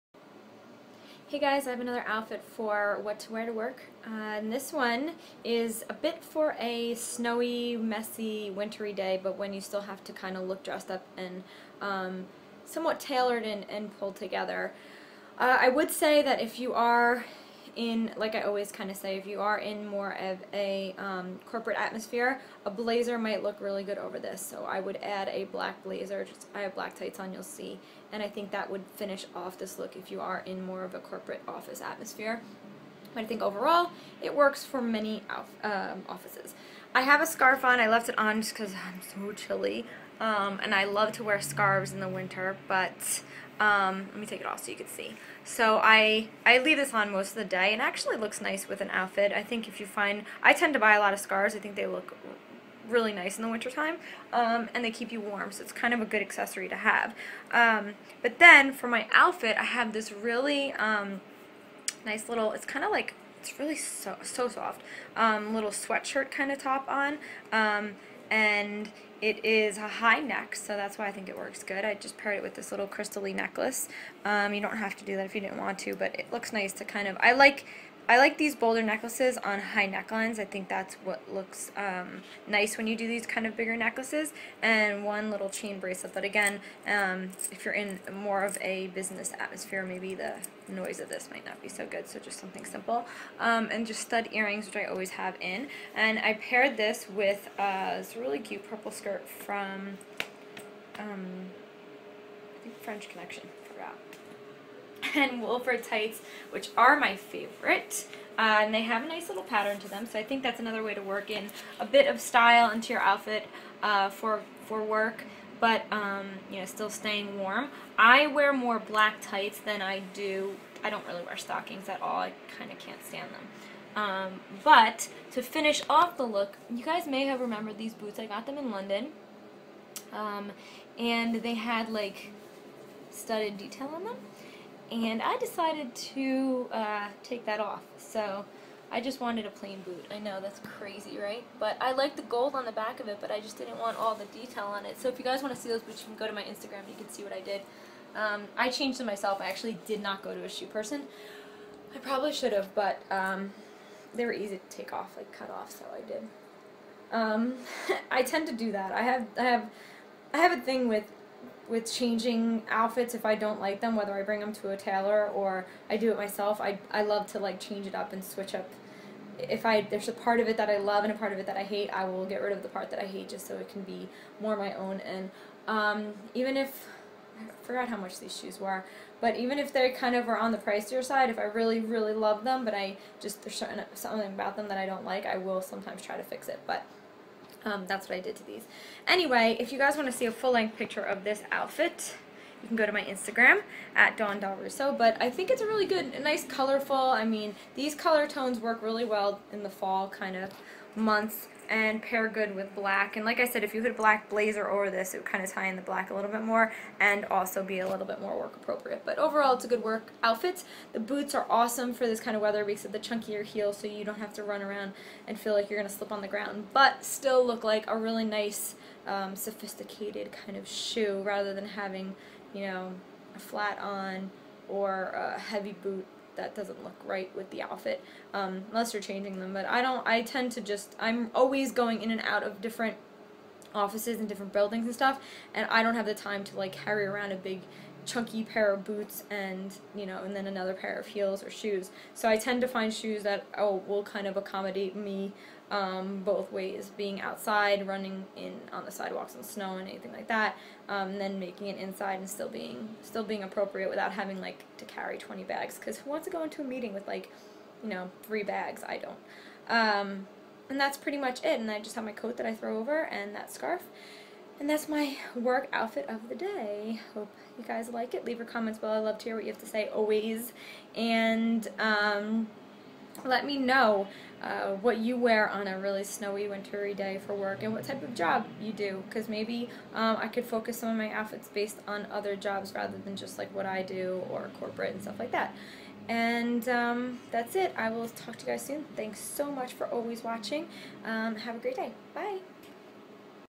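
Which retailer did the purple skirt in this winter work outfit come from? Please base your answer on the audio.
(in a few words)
French Connection.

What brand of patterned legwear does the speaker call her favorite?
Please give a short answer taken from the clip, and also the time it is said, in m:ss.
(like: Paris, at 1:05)
Wolford, at 1:45.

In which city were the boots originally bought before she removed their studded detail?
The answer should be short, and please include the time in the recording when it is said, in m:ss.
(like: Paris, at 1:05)
London, at 2:08.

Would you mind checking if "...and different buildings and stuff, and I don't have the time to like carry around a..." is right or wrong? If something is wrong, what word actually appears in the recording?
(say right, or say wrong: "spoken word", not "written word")
right.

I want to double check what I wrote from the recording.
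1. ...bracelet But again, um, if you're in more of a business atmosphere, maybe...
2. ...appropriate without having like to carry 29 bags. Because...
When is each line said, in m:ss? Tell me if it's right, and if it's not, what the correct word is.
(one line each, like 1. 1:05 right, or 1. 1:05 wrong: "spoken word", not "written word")
1. 1:25 right
2. 4:13 wrong: "20", not "29".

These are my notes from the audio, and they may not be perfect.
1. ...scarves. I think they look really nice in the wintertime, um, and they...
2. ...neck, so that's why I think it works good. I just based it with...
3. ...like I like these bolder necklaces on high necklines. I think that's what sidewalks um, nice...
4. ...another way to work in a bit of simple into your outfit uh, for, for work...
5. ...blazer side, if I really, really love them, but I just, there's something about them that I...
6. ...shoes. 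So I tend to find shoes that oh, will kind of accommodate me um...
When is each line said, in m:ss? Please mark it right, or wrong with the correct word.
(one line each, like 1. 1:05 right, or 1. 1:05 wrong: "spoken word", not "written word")
1. 0:51 right
2. 1:10 wrong: "paired", not "based"
3. 1:17 wrong: "looks", not "sidewalks"
4. 1:50 wrong: "style", not "simple"
5. 3:00 wrong: "pricier", not "blazer"
6. 4:01 right.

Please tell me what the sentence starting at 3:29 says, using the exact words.
But overall, it's a good work outfit.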